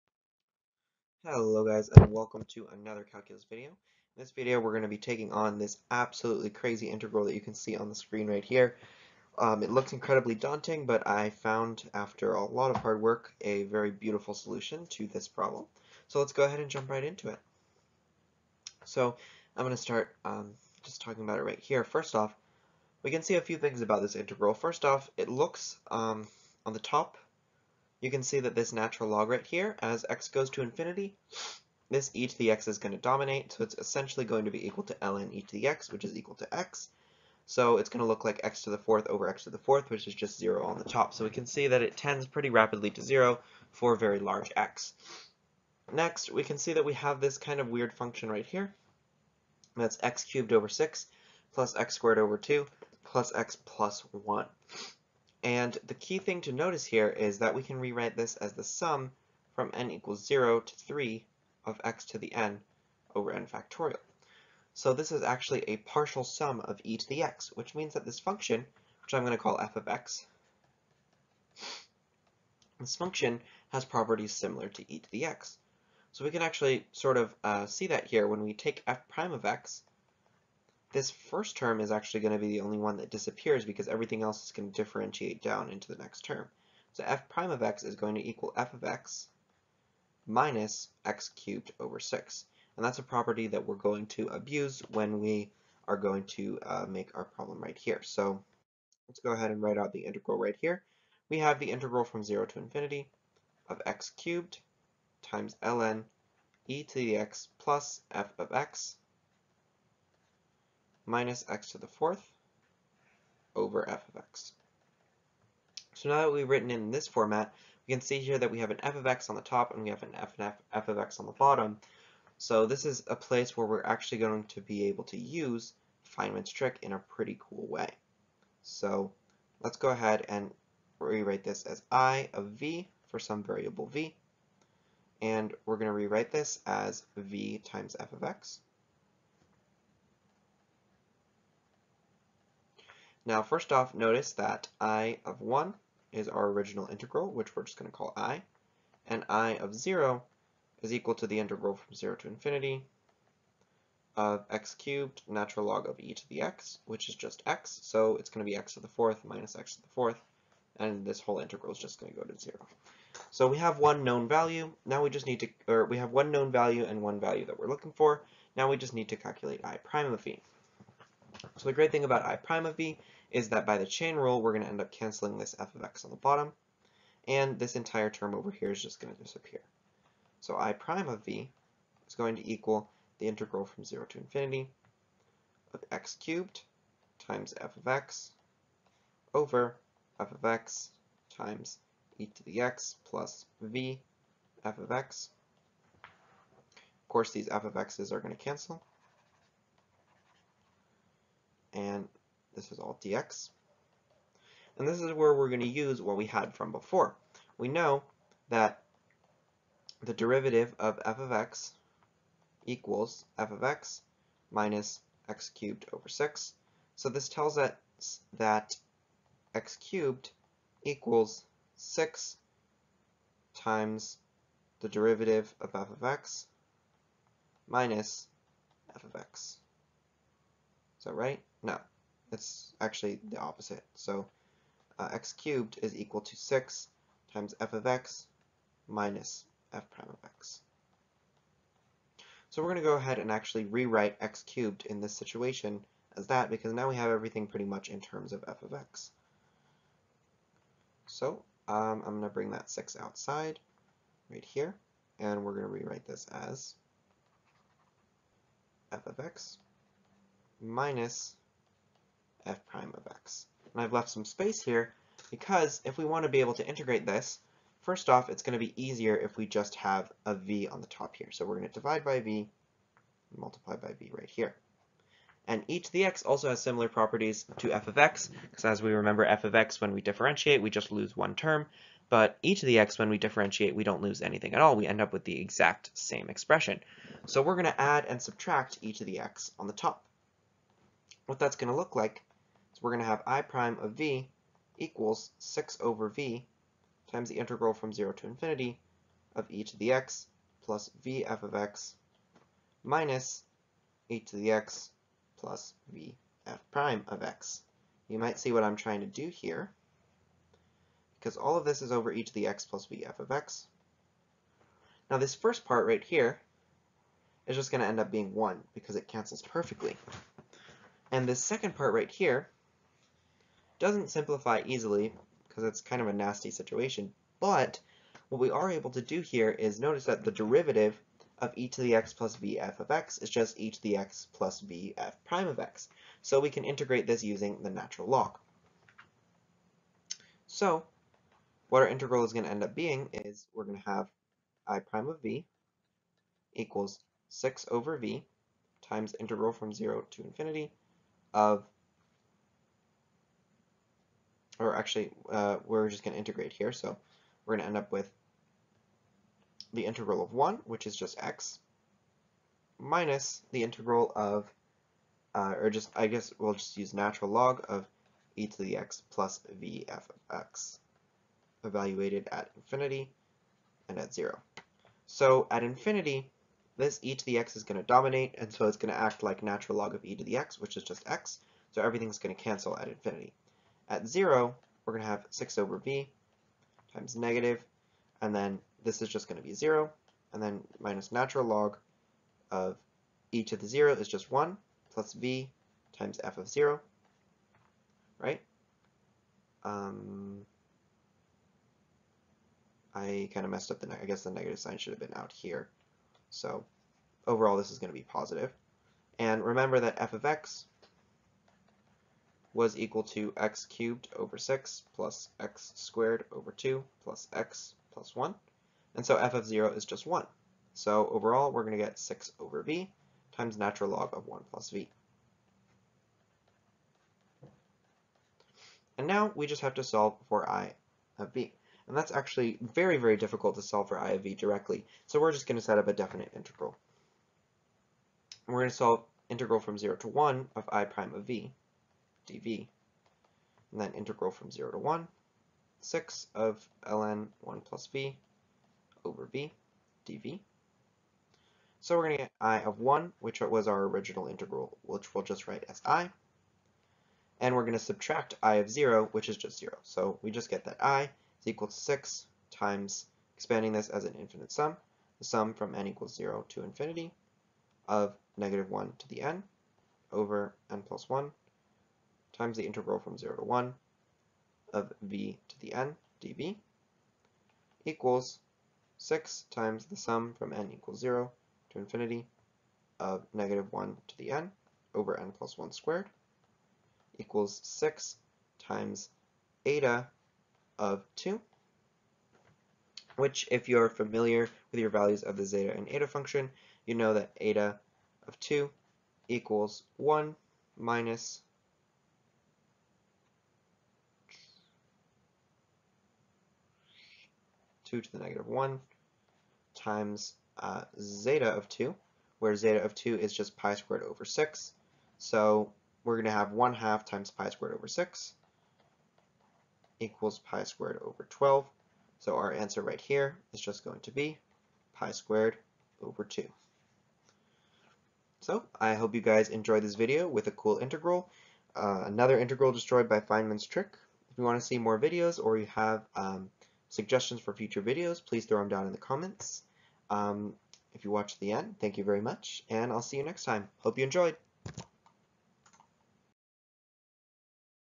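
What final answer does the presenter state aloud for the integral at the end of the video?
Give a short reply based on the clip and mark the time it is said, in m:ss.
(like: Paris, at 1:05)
pi squared over 2, at 8:44.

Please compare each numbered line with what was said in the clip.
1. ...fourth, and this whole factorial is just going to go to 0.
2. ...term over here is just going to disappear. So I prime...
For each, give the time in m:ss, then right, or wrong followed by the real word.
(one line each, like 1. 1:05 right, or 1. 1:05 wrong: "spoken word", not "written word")
1. 2:39 wrong: "integral", not "factorial"
2. 2:58 right.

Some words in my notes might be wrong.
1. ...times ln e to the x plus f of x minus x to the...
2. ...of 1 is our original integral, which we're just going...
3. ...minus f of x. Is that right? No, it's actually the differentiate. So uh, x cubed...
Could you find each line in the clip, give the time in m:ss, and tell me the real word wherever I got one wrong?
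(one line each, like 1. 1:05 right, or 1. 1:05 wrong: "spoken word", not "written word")
1. 1:45 right
2. 2:25 right
3. 3:47 wrong: "opposite", not "differentiate".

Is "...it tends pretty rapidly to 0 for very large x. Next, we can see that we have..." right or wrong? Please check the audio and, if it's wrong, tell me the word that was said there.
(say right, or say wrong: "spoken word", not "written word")
right.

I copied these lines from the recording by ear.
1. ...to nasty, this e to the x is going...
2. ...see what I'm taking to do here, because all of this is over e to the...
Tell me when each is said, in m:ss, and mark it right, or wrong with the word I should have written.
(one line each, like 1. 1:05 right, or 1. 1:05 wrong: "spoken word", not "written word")
1. 0:30 wrong: "infinity", not "nasty"
2. 5:08 wrong: "trying", not "taking".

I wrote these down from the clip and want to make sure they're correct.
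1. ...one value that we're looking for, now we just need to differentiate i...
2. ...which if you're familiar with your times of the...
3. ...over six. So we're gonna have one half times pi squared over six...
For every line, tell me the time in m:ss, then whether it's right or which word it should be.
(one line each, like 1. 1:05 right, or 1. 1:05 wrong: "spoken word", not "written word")
1. 2:47 wrong: "calculate", not "differentiate"
2. 8:13 wrong: "values", not "times"
3. 8:34 right.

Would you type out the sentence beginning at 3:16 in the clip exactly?
Of course, these f of x's are going to cancel and this is all dx.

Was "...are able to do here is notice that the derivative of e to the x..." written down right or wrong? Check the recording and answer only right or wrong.
right.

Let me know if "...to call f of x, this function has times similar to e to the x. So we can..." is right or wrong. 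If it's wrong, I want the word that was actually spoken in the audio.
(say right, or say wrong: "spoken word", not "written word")
wrong: "properties", not "times".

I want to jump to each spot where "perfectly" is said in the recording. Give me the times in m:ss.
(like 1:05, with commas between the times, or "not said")
5:19.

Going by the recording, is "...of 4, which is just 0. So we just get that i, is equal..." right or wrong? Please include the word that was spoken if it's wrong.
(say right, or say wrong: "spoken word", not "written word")
wrong: "0", not "4".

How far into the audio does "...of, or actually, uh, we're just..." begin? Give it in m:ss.
5:51.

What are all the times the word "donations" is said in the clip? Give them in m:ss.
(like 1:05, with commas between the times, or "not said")
not said.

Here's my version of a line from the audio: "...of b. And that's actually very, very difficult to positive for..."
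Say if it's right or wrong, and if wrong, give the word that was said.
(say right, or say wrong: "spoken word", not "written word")
wrong: "solve", not "positive".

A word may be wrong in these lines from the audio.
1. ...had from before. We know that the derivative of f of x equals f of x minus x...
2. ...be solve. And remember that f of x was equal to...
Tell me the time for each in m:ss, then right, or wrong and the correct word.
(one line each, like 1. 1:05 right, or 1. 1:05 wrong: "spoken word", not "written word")
1. 3:26 right
2. 6:47 wrong: "positive", not "solve".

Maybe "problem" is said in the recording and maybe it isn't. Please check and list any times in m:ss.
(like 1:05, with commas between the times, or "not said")
0:15, 1:37.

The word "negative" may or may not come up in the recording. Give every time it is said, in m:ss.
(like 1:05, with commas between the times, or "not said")
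6:27, 6:44, 7:48, 8:03, 8:28.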